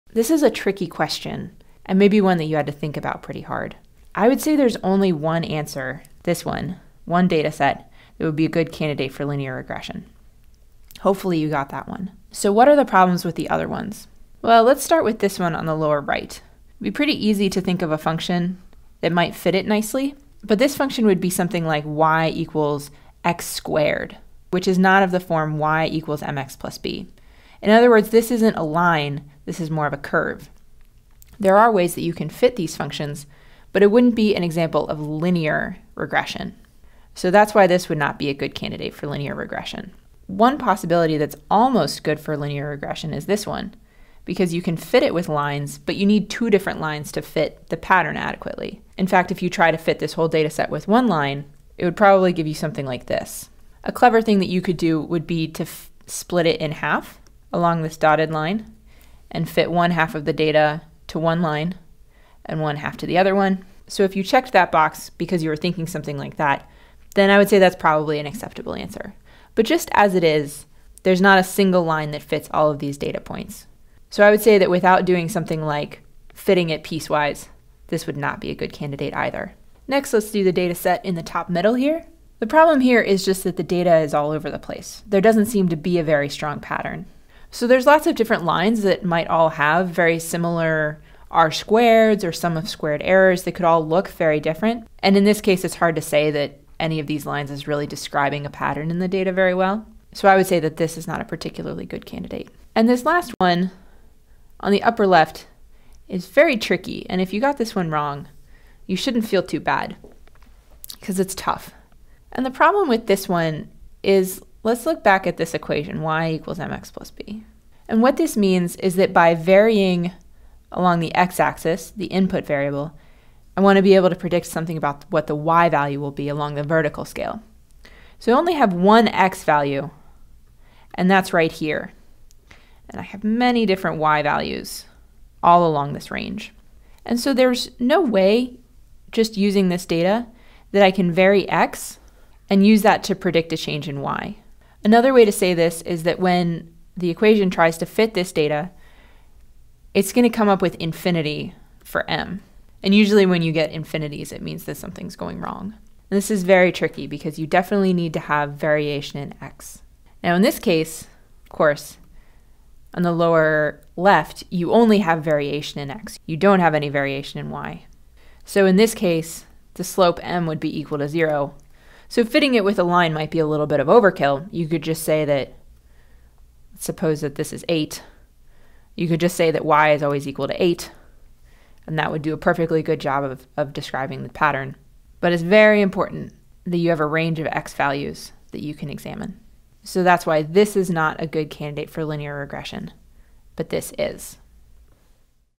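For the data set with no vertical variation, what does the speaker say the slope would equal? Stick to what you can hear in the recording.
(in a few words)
0.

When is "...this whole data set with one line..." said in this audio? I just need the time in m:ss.
0:49.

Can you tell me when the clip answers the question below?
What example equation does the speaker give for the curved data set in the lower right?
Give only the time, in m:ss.
0:21.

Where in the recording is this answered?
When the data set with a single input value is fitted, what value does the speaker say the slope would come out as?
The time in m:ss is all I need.
2:30.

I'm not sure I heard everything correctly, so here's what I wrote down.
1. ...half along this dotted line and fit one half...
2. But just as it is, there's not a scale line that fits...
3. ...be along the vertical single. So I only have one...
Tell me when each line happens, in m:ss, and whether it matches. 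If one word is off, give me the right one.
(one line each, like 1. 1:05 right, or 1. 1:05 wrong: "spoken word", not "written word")
1. 0:56 right
2. 1:09 wrong: "single", not "scale"
3. 2:06 wrong: "scale", not "single".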